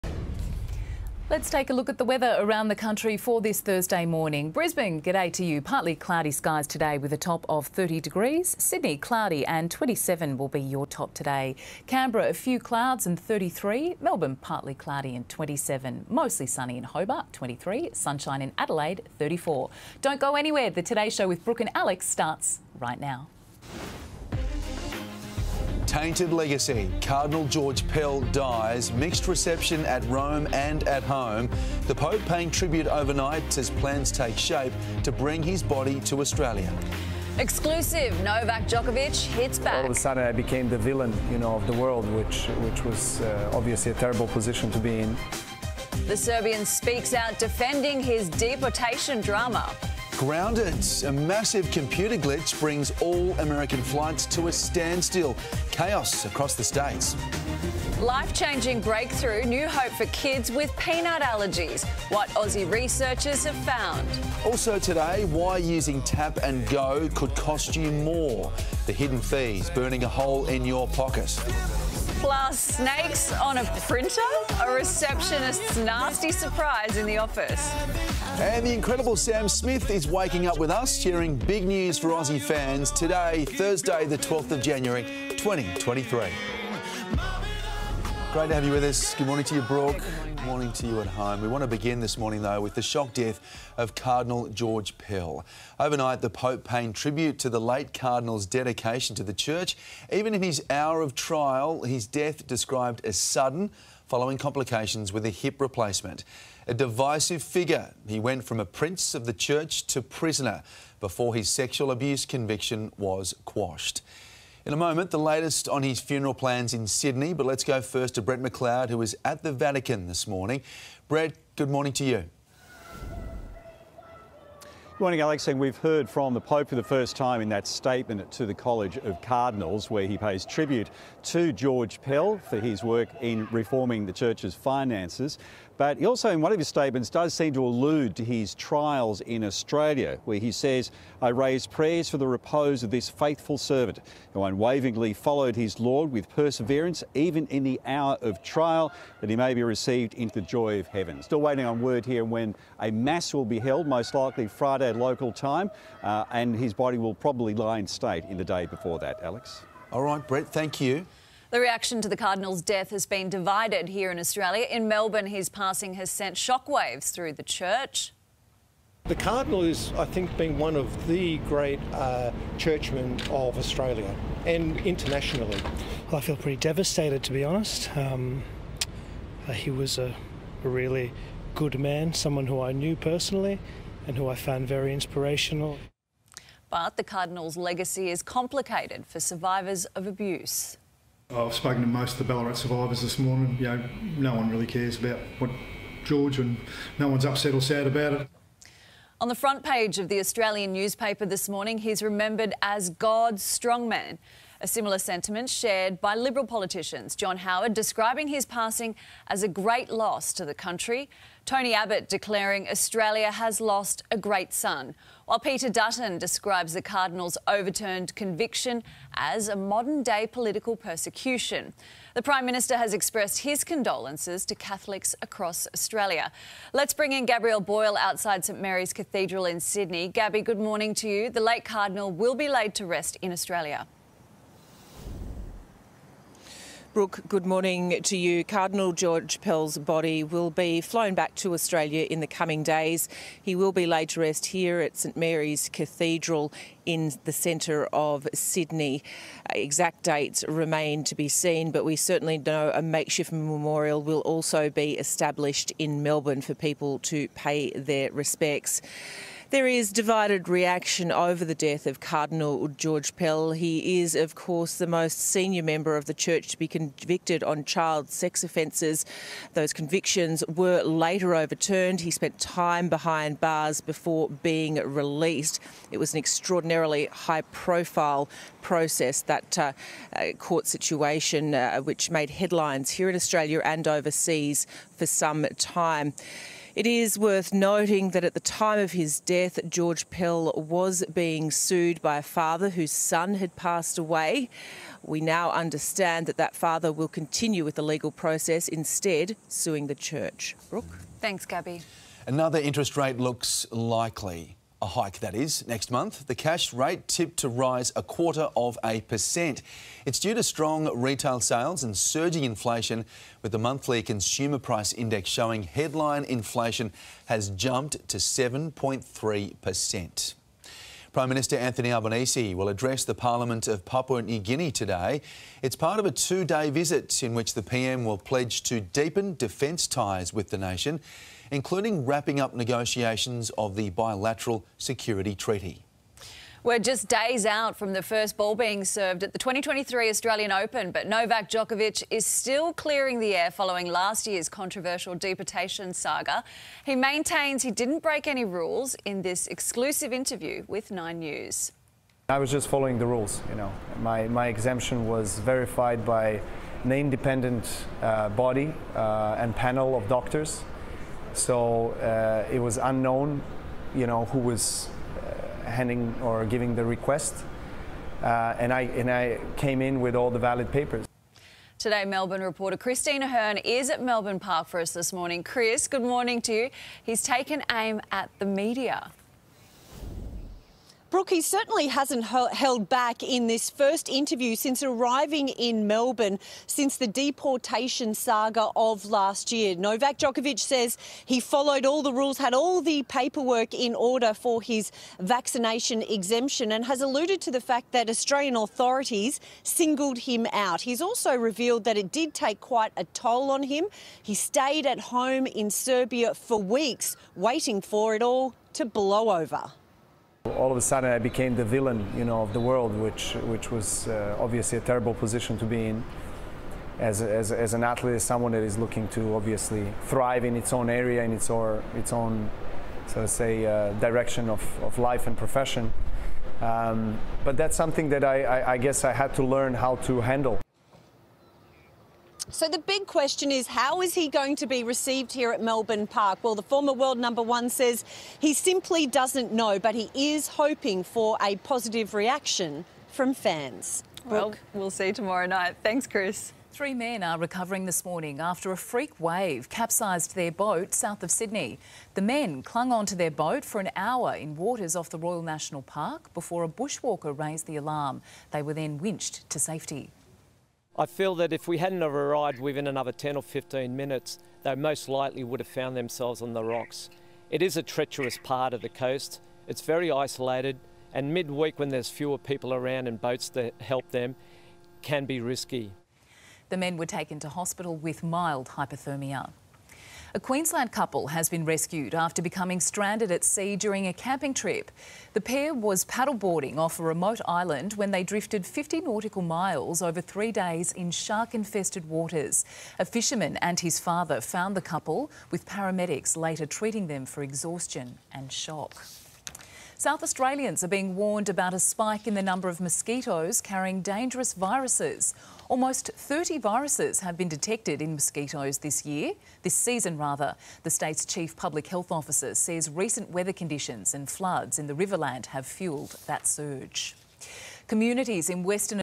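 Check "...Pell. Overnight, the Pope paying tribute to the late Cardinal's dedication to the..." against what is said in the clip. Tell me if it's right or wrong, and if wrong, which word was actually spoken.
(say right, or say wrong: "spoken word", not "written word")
right.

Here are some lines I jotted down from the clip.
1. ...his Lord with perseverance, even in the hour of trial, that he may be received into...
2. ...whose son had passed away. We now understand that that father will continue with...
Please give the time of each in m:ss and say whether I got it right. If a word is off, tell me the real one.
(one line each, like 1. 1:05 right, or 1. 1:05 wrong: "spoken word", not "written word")
1. 2:25 right
2. 4:52 right.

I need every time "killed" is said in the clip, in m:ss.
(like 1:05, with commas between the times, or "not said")
not said.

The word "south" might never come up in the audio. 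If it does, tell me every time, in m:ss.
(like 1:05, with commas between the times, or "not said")
7:30, 8:20.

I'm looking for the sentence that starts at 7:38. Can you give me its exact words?
They were then winched to safety.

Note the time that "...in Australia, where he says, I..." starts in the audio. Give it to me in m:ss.
2:19.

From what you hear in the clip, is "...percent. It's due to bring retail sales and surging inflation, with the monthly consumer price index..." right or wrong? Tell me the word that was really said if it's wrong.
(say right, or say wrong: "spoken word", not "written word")
wrong: "strong", not "bring".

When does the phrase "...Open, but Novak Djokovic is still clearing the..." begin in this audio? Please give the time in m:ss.
5:40.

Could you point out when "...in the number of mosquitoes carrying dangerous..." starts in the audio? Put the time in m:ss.
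8:22.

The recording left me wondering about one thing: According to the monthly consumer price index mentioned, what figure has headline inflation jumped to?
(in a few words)
7.3%.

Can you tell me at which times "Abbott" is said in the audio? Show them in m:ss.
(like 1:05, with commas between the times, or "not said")
3:31.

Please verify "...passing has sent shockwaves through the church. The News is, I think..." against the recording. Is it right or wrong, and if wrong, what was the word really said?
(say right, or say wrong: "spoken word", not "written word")
wrong: "Cardinal", not "News".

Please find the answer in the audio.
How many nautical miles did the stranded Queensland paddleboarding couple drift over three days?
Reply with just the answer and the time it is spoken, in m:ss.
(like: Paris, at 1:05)
50, at 8:08.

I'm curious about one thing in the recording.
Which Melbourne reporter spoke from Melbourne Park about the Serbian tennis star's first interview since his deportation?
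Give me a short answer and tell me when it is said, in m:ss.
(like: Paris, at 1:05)
Christine Ahern, at 6:12.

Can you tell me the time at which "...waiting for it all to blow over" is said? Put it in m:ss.
6:47.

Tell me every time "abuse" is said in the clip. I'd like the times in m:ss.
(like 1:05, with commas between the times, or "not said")
1:51, 3:10.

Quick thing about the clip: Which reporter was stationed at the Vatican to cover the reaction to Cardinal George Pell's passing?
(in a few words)
Brett McLeod.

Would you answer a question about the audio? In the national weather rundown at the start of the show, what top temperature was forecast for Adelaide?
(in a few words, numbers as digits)
34.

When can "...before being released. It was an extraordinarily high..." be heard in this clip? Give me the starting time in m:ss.
4:33.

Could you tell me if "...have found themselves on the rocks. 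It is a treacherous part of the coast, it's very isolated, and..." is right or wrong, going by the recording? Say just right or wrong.
right.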